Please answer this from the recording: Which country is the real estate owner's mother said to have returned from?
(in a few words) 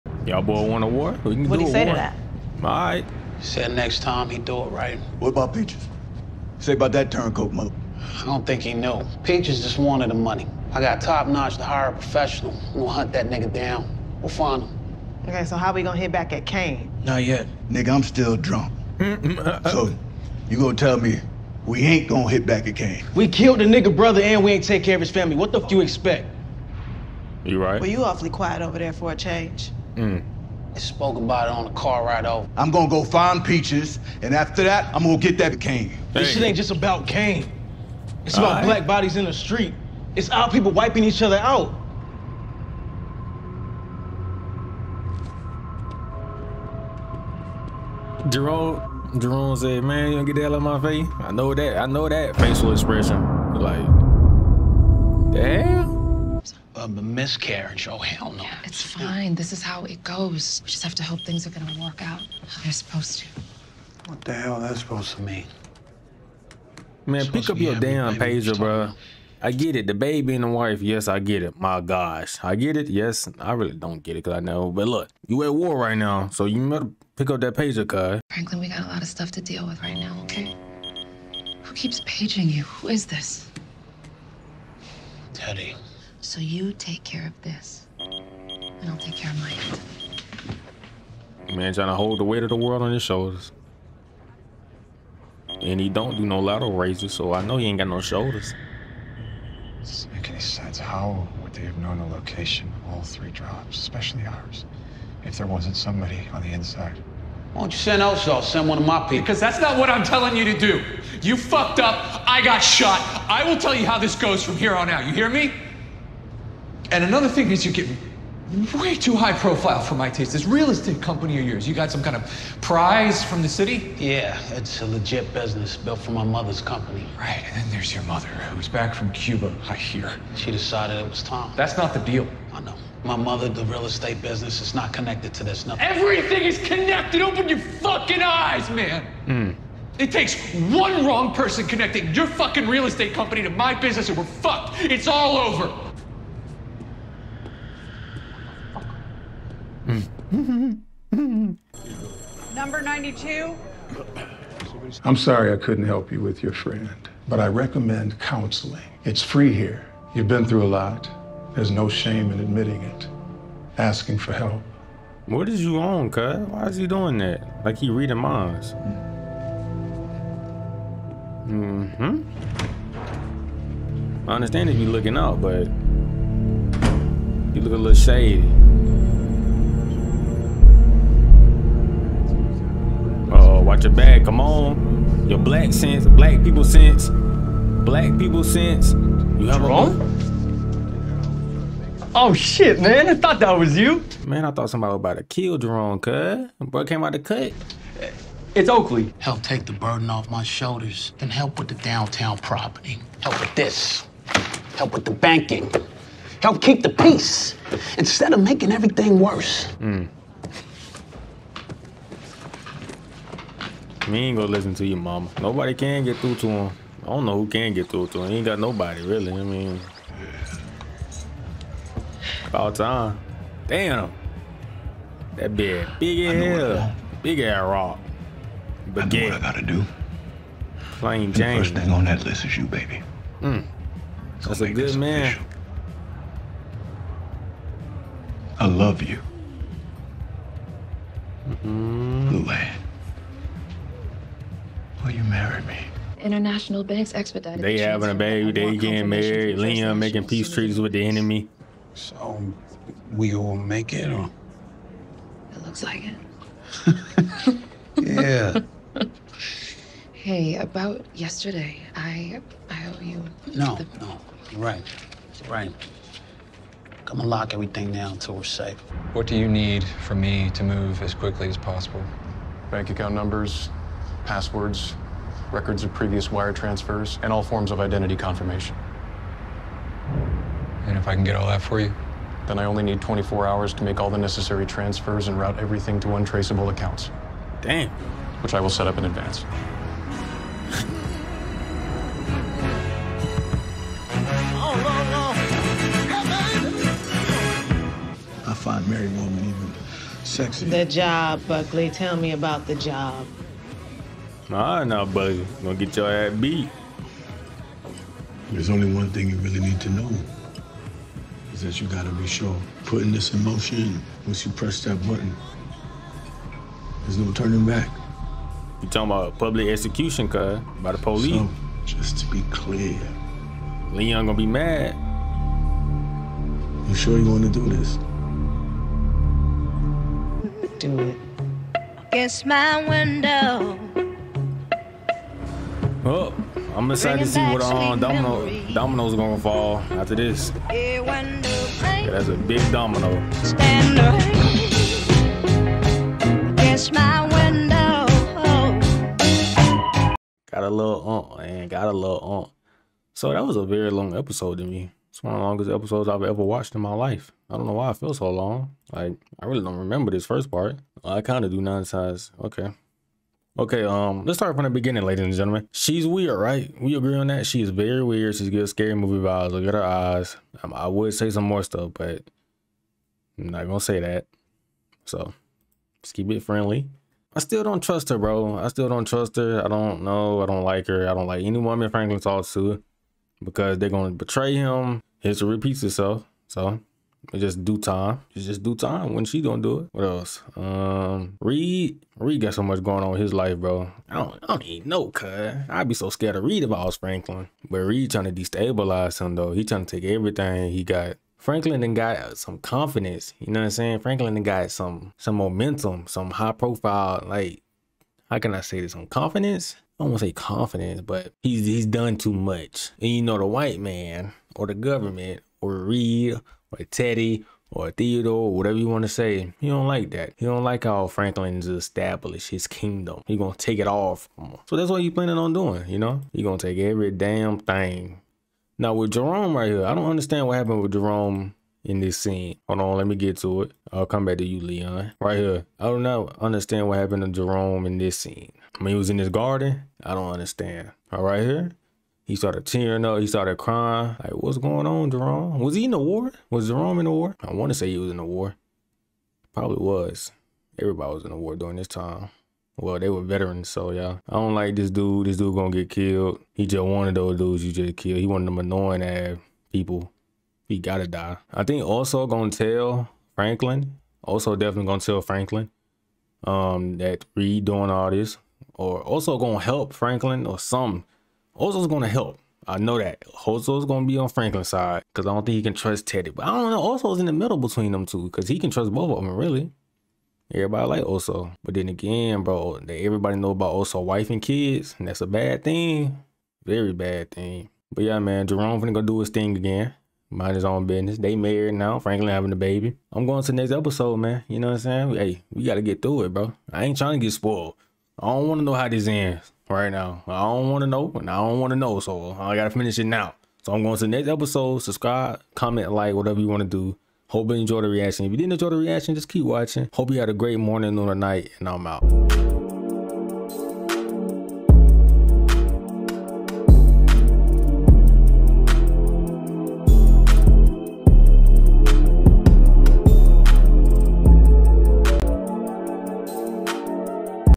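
Cuba.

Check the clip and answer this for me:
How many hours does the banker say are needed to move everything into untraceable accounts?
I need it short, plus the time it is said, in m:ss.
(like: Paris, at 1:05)
24, at 4:43.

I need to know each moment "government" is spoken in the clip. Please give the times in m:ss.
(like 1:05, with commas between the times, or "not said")
6:54.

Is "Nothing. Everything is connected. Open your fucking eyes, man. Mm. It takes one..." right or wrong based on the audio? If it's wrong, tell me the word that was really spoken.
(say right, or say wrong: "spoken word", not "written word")
right.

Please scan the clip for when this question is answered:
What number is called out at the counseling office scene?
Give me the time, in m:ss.
2:32.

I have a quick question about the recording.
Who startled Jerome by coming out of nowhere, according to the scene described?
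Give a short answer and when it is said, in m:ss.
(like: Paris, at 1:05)
Oakley, at 3:18.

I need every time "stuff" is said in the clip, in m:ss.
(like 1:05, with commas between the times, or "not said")
1:19, 6:11.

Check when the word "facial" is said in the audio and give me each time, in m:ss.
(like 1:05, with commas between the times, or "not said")
0:52.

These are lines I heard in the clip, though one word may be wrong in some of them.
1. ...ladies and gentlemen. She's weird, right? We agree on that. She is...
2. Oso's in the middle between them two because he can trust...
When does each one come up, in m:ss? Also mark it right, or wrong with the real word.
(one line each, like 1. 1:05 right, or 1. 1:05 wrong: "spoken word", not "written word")
1. 6:05 right
2. 7:56 right.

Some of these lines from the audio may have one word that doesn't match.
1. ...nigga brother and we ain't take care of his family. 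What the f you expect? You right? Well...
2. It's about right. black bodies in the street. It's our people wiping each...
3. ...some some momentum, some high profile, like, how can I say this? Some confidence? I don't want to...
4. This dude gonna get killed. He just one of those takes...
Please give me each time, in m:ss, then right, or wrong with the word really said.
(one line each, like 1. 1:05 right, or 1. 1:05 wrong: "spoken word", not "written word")
1. 0:23 right
2. 0:38 right
3. 6:44 right
4. 7:35 wrong: "dudes", not "takes".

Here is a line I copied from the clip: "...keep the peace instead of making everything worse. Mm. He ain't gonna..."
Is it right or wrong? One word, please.
right.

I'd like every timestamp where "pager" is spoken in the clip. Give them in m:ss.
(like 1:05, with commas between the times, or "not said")
1:08, 1:17.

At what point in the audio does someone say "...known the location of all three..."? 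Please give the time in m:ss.
1:41.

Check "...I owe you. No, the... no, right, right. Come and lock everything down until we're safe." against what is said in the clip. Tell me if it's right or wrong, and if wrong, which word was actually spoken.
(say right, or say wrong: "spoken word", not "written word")
right.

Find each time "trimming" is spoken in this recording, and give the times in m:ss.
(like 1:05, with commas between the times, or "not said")
not said.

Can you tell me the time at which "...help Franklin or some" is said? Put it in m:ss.
7:49.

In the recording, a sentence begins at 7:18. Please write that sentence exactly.
I mean, he was in his garden.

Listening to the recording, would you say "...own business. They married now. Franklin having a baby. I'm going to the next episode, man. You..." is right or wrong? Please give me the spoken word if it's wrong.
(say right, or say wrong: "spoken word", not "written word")
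right.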